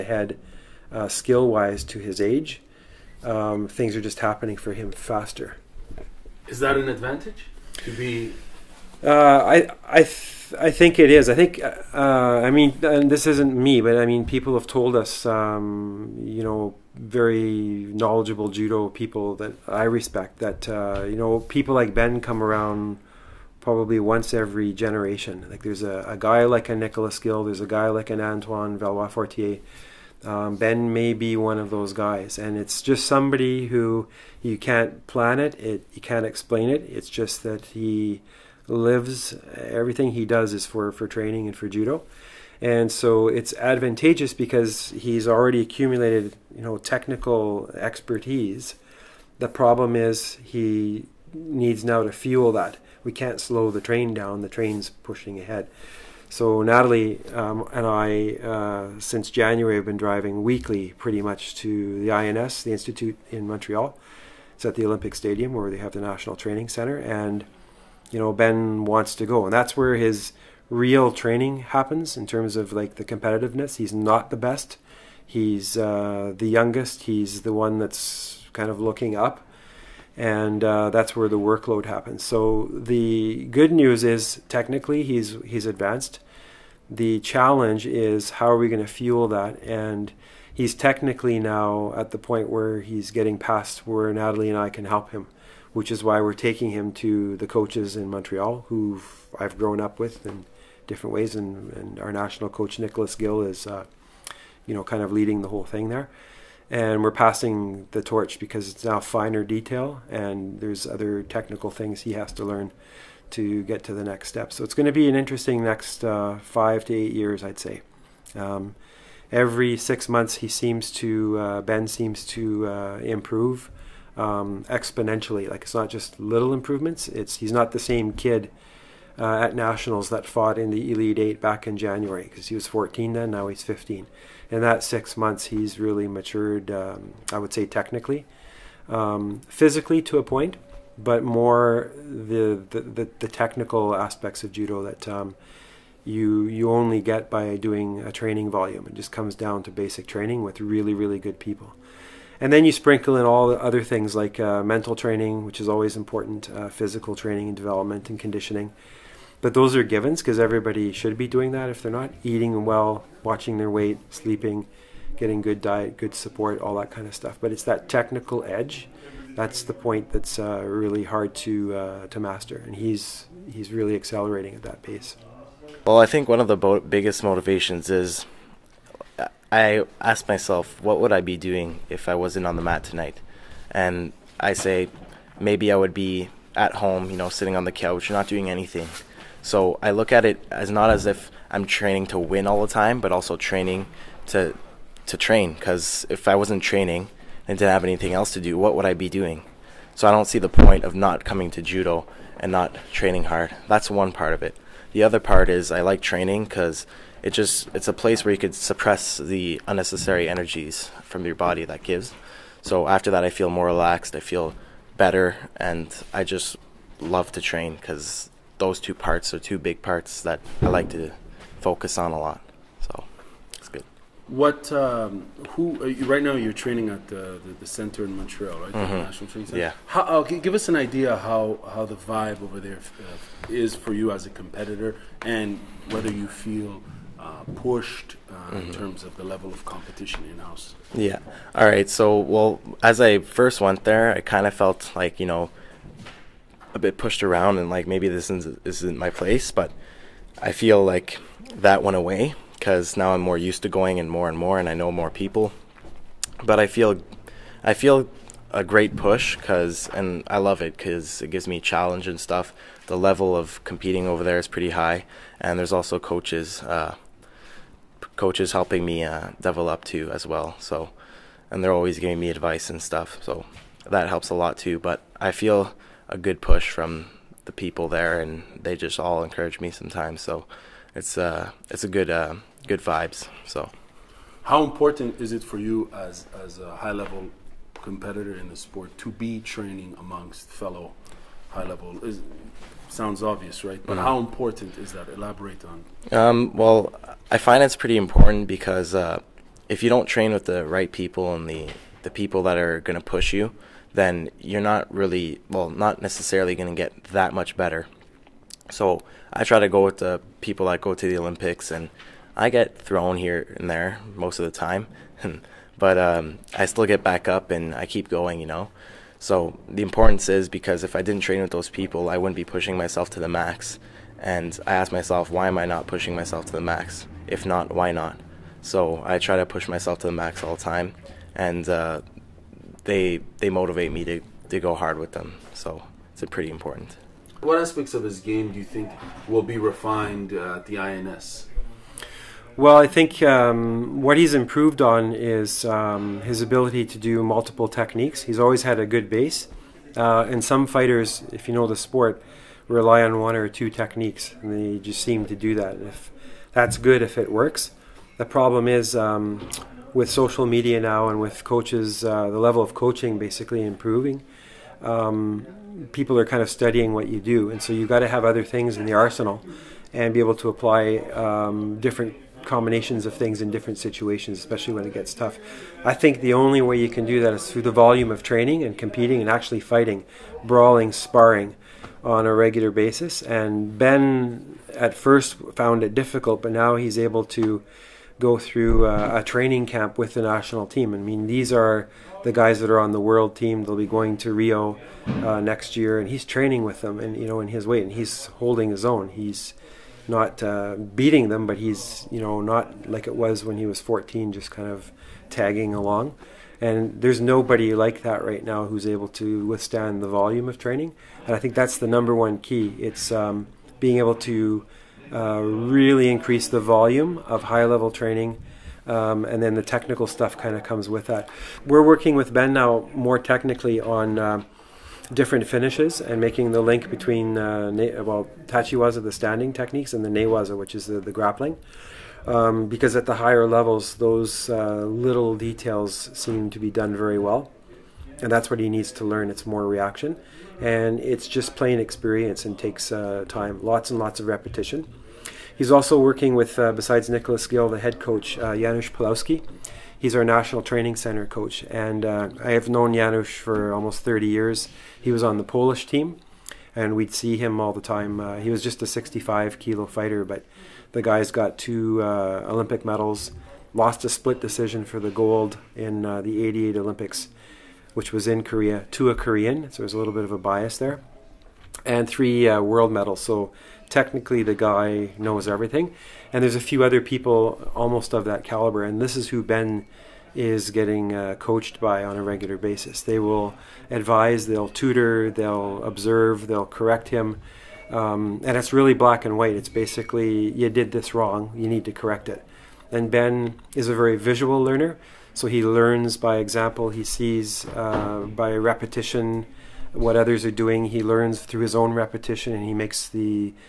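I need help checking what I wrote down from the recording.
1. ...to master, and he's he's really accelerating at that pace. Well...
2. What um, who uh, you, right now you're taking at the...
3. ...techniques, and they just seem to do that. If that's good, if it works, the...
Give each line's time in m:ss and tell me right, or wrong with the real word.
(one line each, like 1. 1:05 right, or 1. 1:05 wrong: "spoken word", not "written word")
1. 2:52 right
2. 3:44 wrong: "training", not "taking"
3. 5:53 right.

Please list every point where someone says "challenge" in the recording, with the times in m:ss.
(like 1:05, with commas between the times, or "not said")
1:27, 4:21.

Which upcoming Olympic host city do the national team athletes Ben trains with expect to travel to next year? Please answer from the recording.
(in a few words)
Rio.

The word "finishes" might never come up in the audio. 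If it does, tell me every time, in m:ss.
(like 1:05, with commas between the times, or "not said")
7:05.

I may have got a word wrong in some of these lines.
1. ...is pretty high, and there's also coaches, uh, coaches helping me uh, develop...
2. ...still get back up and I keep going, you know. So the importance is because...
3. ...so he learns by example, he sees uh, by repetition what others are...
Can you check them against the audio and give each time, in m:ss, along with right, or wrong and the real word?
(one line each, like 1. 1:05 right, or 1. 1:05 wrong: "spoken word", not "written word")
1. 4:24 right
2. 5:16 right
3. 8:15 right.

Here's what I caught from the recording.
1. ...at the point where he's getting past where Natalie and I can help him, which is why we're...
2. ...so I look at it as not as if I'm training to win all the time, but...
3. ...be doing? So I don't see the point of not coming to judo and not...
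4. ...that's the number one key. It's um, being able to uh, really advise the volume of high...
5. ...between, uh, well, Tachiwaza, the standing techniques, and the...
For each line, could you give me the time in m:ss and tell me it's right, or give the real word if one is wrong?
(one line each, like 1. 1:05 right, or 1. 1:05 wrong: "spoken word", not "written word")
1. 1:31 right
2. 3:09 right
3. 3:18 right
4. 6:51 wrong: "increase", not "advise"
5. 7:06 right.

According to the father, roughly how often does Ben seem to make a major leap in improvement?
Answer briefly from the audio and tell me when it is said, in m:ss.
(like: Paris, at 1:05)
Every 6 months, at 1:59.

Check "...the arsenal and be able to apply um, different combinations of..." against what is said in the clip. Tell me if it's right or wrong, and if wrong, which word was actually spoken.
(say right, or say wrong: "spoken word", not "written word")
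right.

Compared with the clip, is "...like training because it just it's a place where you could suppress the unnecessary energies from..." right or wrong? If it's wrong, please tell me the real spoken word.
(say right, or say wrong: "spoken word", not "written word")
right.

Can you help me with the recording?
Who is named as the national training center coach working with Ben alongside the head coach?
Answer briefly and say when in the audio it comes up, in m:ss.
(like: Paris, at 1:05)
Janusz Pawlowski, at 7:28.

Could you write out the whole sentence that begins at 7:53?
So technically the guy knows everything.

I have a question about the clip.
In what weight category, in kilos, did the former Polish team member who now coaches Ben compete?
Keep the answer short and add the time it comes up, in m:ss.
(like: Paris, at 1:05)
65 kilo, at 7:38.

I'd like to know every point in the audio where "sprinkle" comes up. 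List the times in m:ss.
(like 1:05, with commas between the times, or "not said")
2:32.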